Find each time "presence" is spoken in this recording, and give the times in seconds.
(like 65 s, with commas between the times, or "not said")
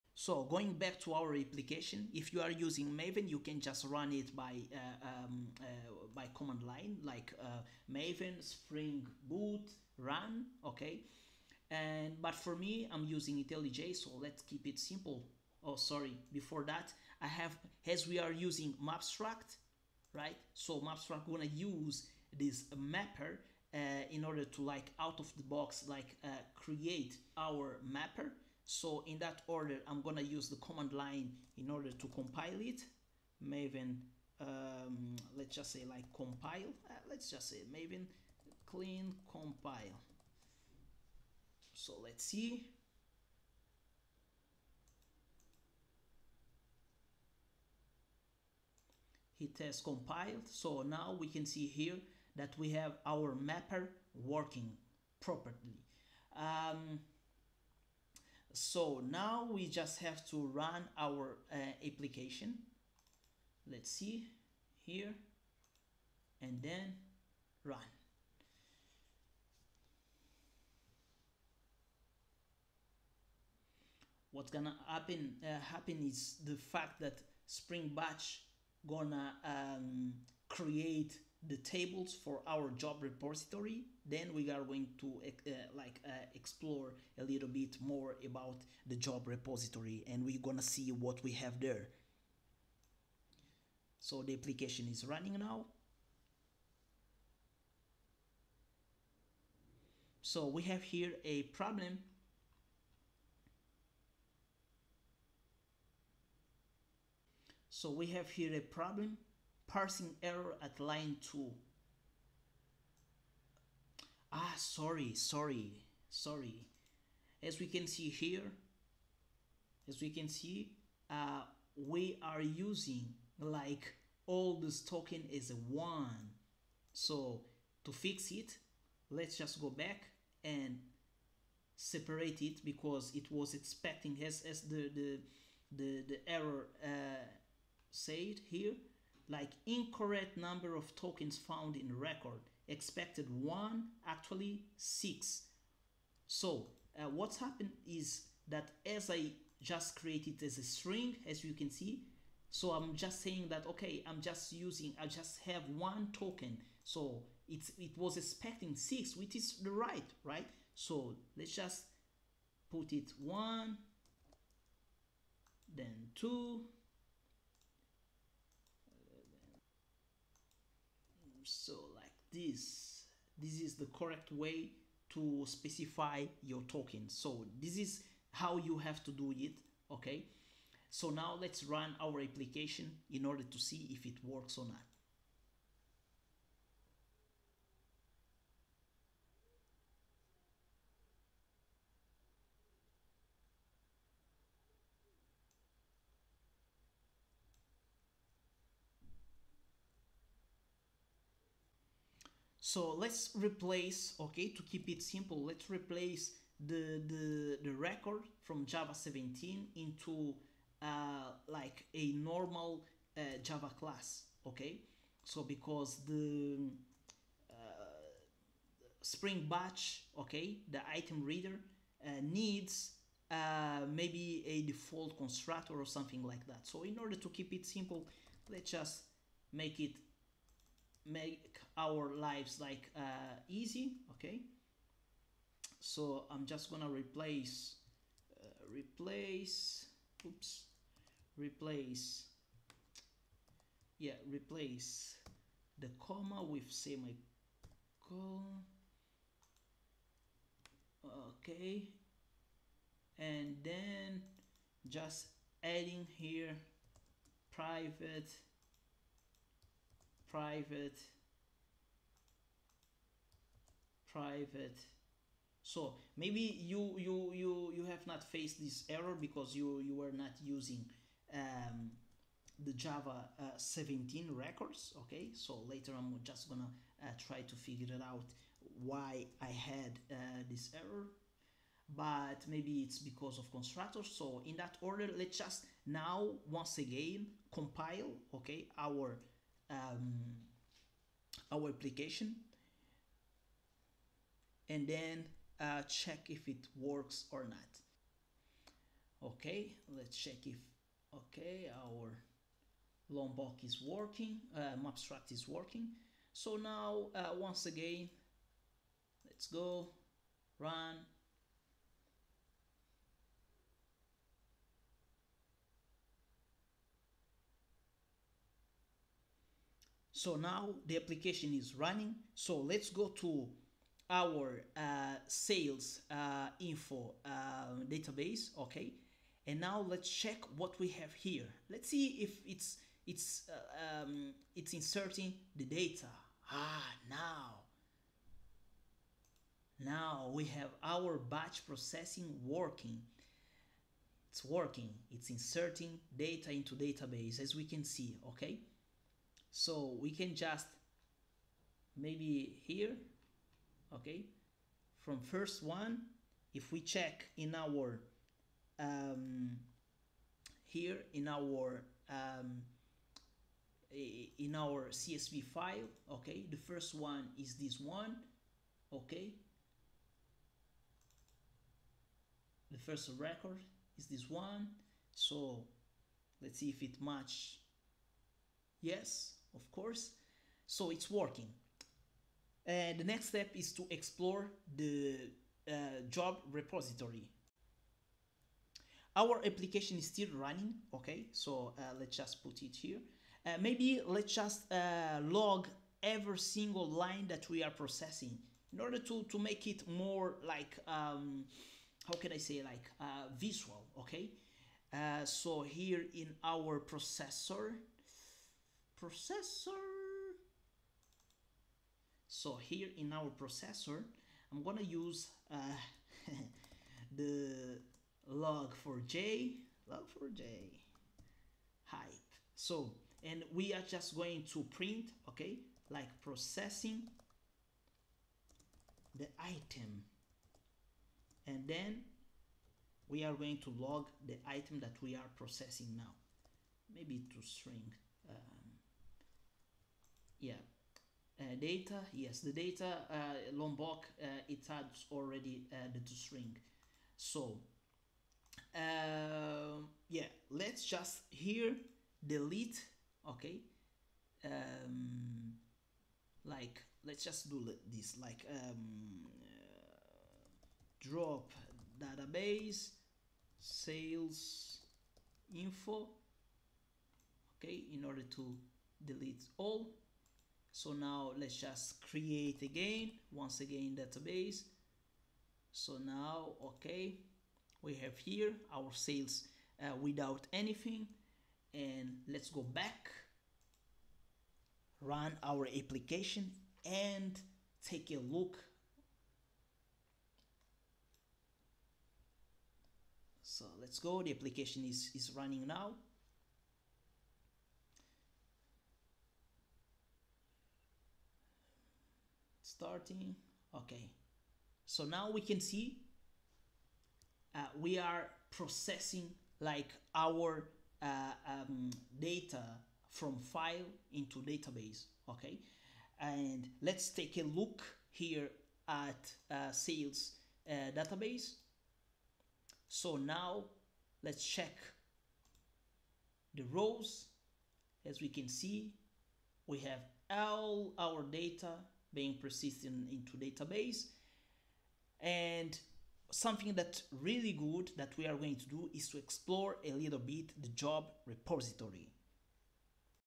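not said.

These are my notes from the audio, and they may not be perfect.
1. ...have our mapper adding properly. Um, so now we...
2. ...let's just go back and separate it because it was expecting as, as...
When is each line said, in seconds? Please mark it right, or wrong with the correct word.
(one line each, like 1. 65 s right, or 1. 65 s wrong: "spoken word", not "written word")
1. 52 s wrong: "working", not "adding"
2. 129 s right.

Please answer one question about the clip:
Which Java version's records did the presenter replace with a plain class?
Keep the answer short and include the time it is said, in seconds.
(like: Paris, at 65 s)
Java 17, at 208 s.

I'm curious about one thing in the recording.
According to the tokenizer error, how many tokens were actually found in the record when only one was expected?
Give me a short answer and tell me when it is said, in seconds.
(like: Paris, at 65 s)
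6, at 144 s.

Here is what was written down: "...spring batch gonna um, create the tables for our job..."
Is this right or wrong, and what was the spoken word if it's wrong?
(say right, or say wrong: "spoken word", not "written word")
right.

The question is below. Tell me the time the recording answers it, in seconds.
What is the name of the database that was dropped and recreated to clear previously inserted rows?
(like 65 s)
463 s.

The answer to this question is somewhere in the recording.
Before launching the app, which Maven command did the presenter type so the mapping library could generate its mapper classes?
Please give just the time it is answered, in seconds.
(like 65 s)
37 s.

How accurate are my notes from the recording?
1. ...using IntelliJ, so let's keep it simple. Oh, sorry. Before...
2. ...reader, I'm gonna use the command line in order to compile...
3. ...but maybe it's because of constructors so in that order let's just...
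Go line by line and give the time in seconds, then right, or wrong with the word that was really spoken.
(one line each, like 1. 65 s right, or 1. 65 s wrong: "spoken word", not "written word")
1. 13 s right
2. 29 s wrong: "order", not "reader"
3. 281 s right.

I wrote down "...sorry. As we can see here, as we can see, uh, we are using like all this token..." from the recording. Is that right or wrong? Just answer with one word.
right.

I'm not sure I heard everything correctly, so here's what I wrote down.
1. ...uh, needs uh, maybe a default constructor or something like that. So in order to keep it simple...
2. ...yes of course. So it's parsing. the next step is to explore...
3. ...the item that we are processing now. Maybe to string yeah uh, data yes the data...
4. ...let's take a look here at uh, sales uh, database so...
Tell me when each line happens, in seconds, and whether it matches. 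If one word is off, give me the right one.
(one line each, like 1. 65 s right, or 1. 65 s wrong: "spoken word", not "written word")
1. 222 s right
2. 378 s wrong: "working", not "parsing"
3. 434 s right
4. 516 s right.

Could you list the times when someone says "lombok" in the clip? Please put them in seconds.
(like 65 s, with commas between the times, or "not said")
303 s, 443 s.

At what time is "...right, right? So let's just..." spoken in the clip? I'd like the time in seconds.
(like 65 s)
159 s.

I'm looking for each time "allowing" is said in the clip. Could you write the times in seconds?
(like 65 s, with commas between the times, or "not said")
not said.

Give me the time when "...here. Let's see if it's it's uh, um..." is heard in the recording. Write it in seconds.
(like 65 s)
331 s.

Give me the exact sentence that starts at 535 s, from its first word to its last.
And something that really good that we are going to do is to explore a little bit the job repository.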